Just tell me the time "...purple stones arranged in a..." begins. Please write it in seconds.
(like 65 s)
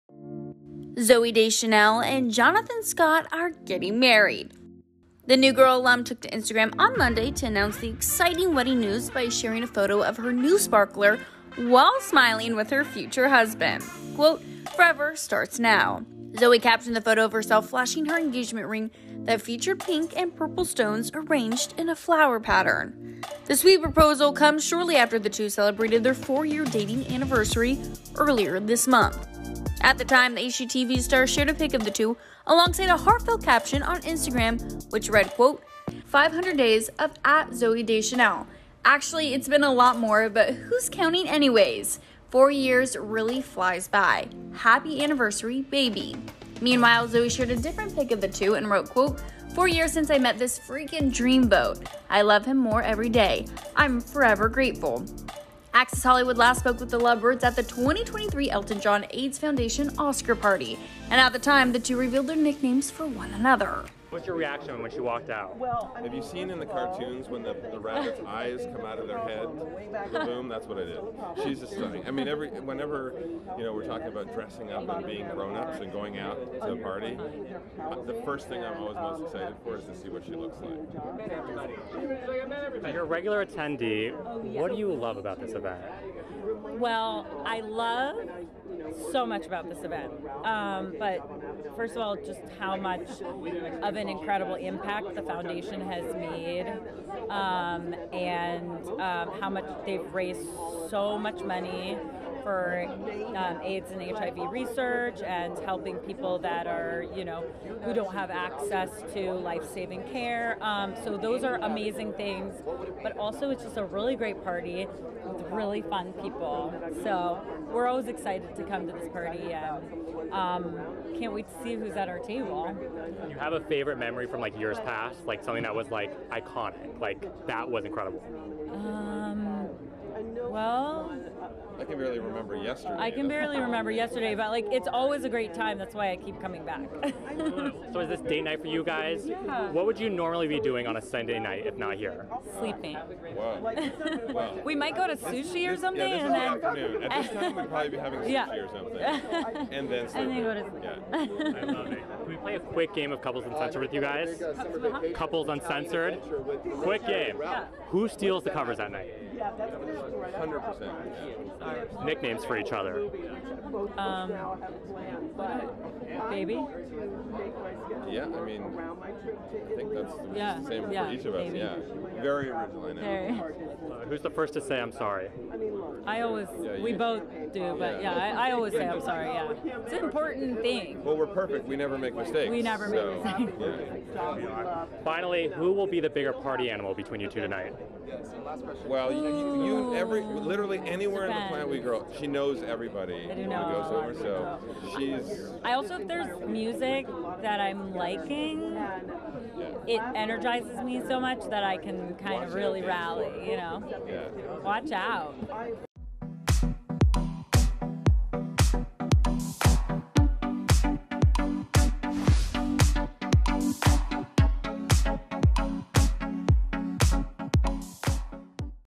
20 s.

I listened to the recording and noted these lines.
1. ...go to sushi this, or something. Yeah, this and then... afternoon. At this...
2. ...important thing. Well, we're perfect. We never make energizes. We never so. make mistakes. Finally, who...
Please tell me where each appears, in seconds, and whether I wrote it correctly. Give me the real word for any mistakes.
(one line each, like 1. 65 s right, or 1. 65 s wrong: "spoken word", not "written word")
1. 144 s right
2. 180 s wrong: "mistakes", not "energizes".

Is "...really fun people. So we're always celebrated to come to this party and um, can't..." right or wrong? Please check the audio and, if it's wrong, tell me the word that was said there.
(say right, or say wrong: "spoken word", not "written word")
wrong: "excited", not "celebrated".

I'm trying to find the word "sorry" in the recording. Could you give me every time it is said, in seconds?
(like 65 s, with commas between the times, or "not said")
174 s, 179 s.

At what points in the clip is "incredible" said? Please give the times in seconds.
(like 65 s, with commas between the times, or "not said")
94 s, 127 s.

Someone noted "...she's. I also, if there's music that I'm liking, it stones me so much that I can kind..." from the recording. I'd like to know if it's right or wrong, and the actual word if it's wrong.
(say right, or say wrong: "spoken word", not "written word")
wrong: "energizes", not "stones".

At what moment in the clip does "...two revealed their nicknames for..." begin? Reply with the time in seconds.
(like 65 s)
61 s.